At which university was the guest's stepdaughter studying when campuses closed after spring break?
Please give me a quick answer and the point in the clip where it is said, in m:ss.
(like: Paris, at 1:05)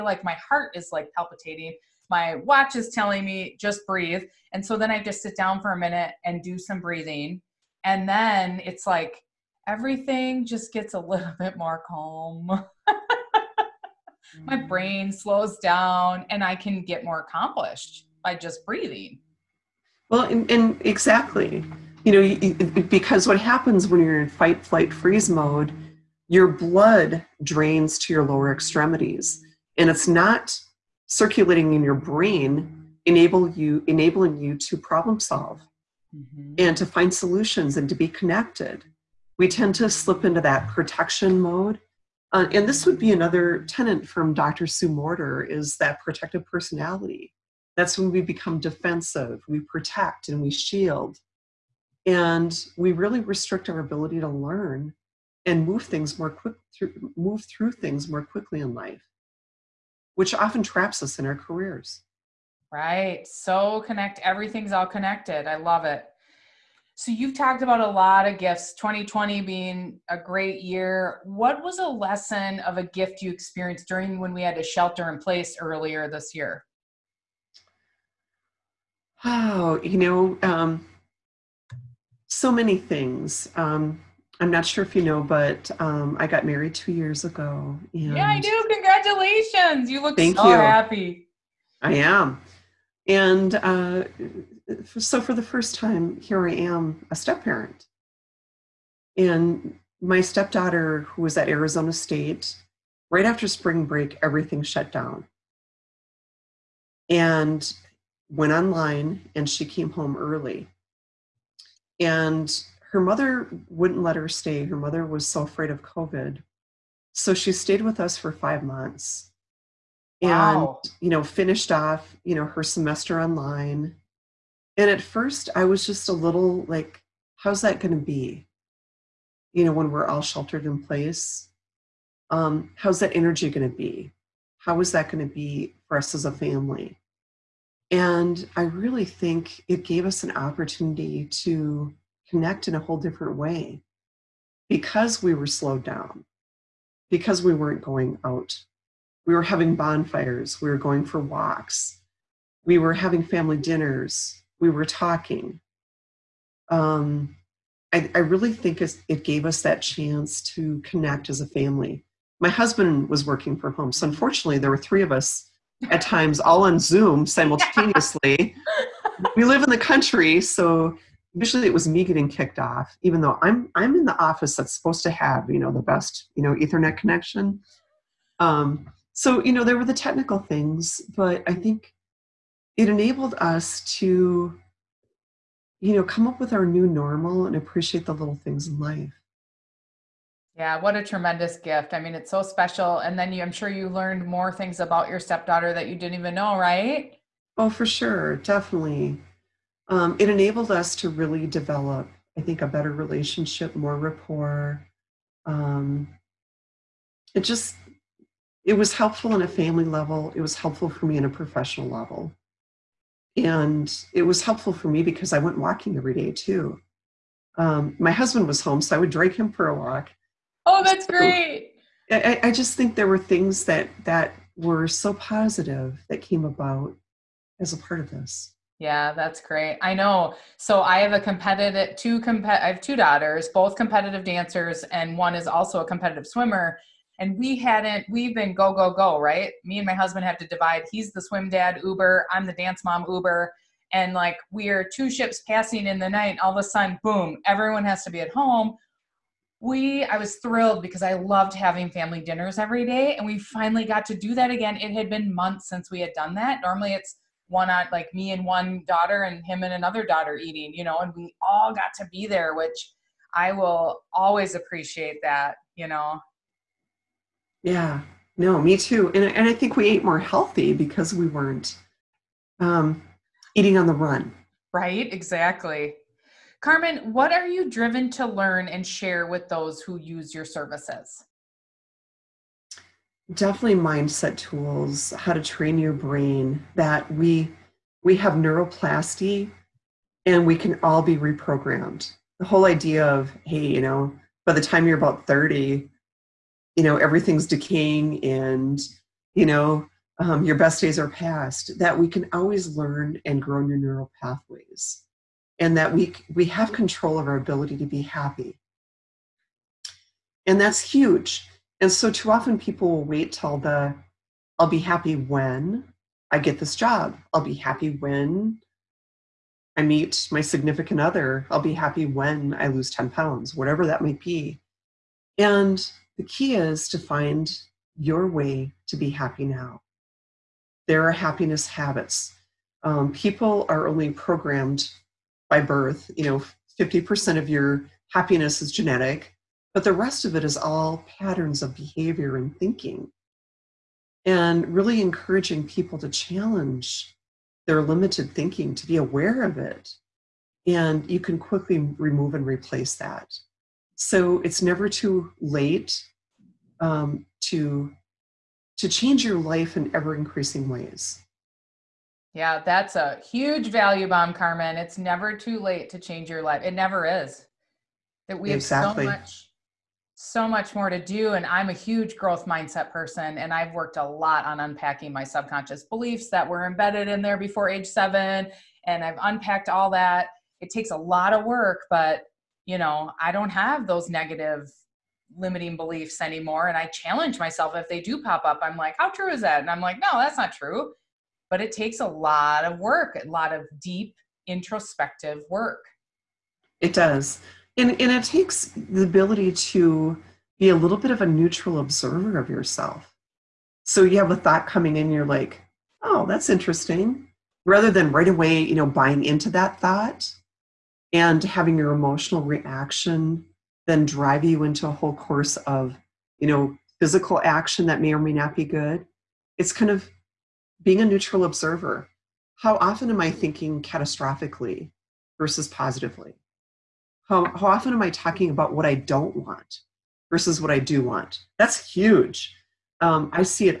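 Arizona State, at 1:41.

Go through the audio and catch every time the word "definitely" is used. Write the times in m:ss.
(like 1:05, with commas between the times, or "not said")
3:18, 4:43.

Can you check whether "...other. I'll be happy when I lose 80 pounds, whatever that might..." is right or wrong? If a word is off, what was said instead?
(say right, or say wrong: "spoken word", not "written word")
wrong: "10", not "80".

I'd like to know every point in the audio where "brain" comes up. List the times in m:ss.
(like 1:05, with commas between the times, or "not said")
0:14, 0:31, 4:45.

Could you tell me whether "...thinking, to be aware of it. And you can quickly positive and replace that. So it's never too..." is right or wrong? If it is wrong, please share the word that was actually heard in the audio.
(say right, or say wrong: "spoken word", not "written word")
wrong: "remove", not "positive".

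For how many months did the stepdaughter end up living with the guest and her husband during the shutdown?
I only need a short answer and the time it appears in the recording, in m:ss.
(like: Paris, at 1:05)
5, at 1:58.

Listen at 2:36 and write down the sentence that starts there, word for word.
Um, I, I really think it gave us that chance to connect as a family.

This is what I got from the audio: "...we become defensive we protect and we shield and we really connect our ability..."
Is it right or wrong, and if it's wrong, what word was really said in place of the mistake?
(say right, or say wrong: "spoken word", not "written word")
wrong: "restrict", not "connect".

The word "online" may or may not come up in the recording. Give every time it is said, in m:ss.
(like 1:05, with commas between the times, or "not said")
1:48, 2:03.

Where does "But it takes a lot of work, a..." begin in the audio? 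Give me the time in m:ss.
6:31.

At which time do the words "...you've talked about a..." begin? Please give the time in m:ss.
1:07.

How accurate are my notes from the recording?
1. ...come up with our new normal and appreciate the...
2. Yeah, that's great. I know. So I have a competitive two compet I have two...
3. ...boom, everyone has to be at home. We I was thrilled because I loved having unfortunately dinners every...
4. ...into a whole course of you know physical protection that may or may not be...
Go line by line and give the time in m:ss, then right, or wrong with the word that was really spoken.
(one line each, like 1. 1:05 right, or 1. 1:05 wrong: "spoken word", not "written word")
1. 3:06 right
2. 3:48 right
3. 4:07 wrong: "family", not "unfortunately"
4. 6:54 wrong: "action", not "protection".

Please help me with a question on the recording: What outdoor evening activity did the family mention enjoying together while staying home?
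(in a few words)
Bonfires.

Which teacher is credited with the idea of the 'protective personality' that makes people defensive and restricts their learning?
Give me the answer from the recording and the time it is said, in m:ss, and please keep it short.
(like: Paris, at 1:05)
Dr Sue Morter, at 0:44.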